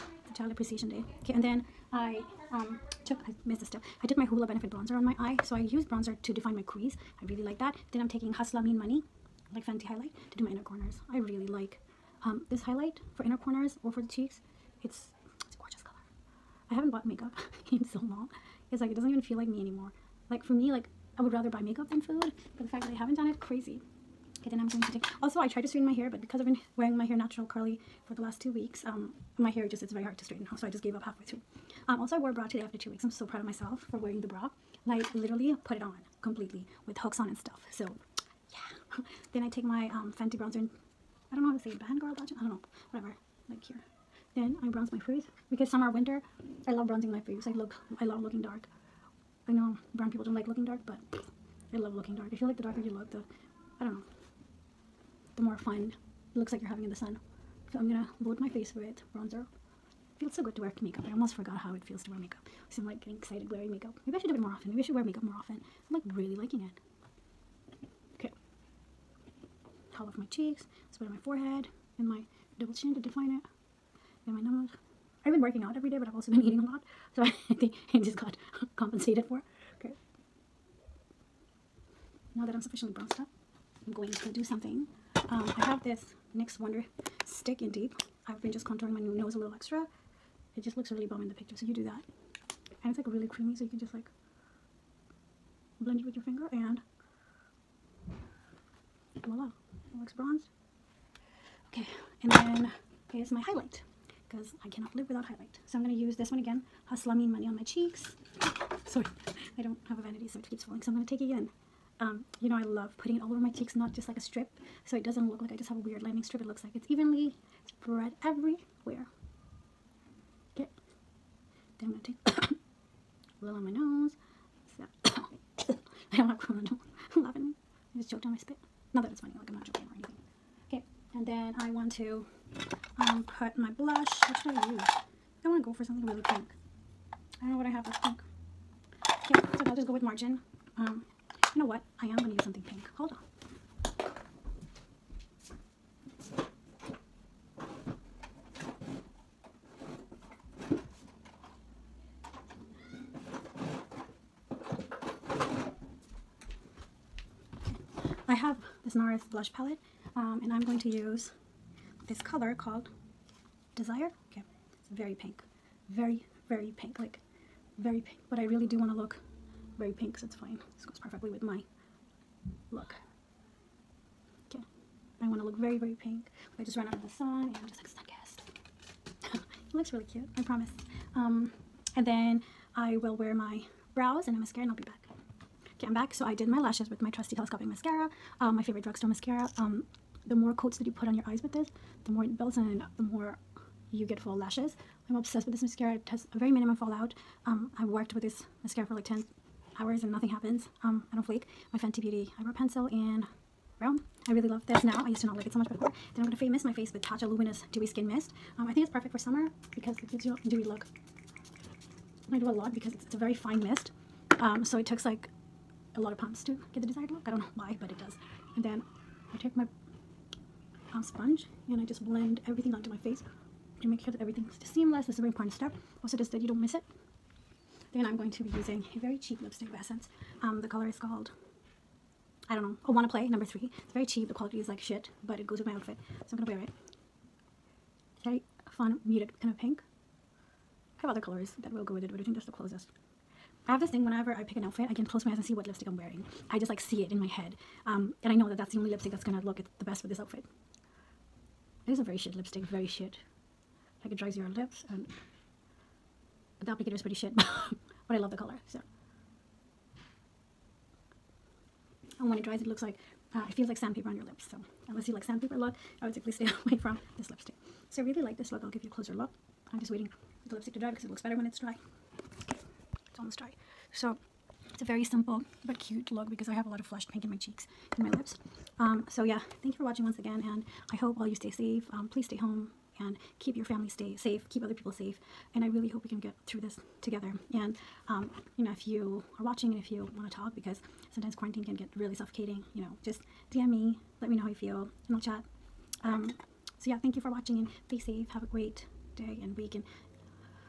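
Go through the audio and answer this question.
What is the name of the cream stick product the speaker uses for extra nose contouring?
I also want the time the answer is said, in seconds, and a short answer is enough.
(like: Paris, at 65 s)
NYX Wonder Stick, at 86 s.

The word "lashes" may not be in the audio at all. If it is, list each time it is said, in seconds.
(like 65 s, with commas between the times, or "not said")
186 s, 194 s.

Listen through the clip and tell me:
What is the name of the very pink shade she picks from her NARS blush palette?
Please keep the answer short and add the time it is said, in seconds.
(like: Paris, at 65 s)
Desire, at 163 s.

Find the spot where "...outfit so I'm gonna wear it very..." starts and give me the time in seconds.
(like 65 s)
235 s.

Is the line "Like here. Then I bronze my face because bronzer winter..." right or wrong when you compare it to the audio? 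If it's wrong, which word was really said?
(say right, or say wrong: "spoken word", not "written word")
wrong: "summer", not "bronzer".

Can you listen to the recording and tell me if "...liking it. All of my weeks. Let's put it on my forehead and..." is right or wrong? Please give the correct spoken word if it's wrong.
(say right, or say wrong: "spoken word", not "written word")
wrong: "cheeks", not "weeks".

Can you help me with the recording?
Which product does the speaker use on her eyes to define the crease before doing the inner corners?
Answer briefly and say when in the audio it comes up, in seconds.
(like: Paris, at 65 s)
Hoola Benefit Bronzer, at 4 s.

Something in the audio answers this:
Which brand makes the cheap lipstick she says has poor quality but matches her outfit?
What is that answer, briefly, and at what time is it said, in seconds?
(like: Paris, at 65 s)
Essence, at 229 s.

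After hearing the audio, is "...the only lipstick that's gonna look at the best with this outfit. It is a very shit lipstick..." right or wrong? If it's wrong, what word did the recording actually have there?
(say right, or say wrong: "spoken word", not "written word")
right.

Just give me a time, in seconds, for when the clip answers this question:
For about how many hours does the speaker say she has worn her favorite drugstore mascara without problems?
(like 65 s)
199 s.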